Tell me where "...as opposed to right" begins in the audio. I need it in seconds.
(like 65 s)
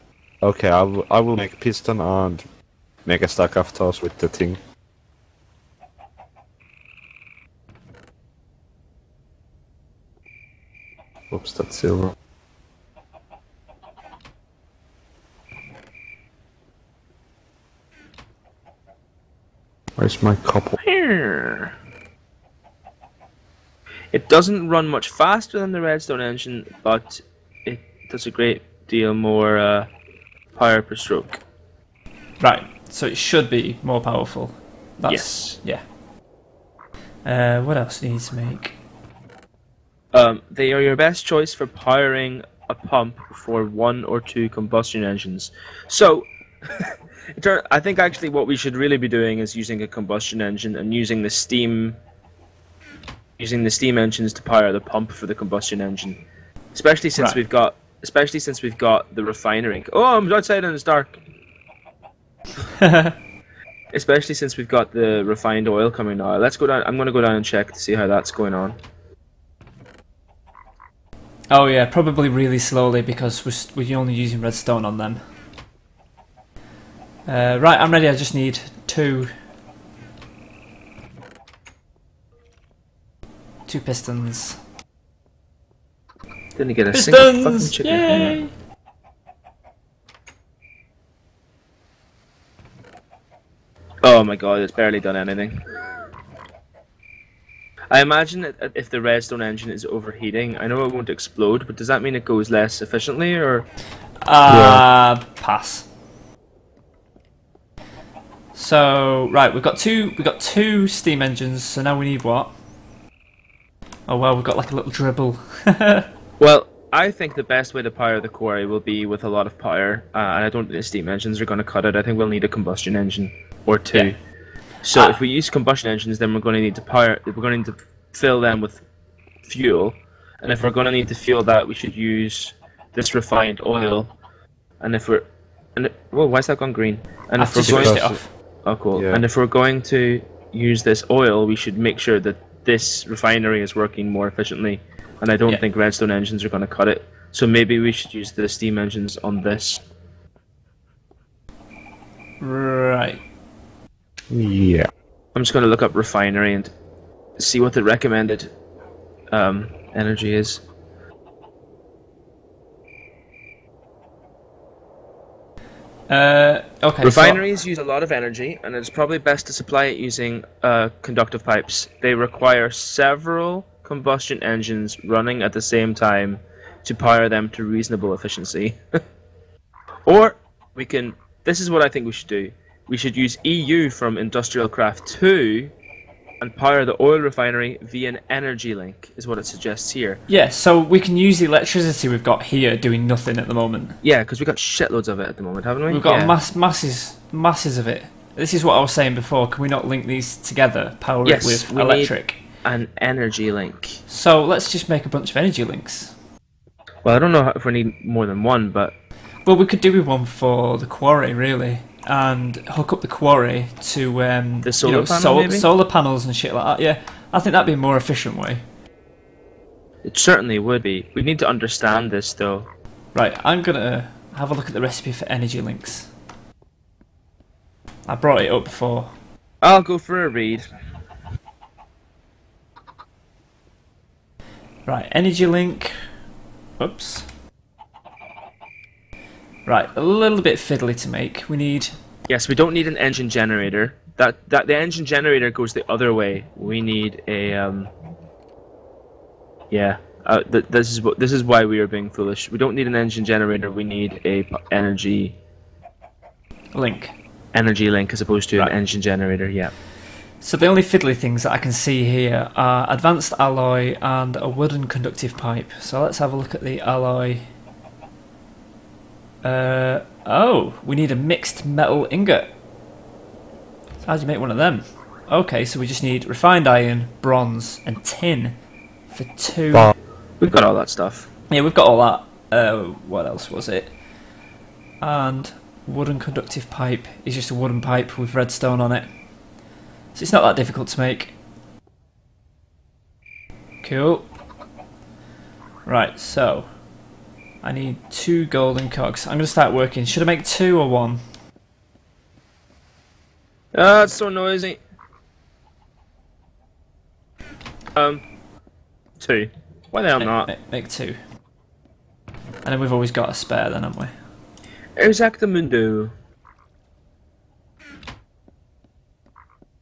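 258 s.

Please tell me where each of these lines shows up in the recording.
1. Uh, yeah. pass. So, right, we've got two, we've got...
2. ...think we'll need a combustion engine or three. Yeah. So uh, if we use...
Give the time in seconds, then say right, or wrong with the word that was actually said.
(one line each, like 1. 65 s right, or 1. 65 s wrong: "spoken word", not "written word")
1. 104 s right
2. 122 s wrong: "two", not "three".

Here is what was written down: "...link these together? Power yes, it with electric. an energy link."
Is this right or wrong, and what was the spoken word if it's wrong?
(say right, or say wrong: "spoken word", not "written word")
right.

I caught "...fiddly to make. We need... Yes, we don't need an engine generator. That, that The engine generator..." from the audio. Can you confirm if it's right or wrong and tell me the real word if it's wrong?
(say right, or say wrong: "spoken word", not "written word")
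right.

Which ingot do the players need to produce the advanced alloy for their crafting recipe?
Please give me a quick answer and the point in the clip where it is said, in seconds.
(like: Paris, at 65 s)
mixed metal ingot, at 271 s.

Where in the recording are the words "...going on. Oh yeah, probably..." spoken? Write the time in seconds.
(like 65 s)
68 s.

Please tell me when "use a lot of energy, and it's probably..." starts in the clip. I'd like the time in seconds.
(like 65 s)
167 s.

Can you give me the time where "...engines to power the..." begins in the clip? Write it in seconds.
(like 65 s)
53 s.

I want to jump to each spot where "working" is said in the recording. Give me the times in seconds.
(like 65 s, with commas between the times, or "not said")
143 s, 299 s.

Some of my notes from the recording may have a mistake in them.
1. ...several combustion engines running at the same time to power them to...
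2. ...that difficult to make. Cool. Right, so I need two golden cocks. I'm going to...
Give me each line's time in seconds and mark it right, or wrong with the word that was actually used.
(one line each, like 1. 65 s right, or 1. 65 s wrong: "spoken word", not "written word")
1. 172 s right
2. 290 s right.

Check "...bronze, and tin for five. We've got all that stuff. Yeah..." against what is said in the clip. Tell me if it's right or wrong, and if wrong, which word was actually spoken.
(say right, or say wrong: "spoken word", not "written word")
wrong: "two", not "five".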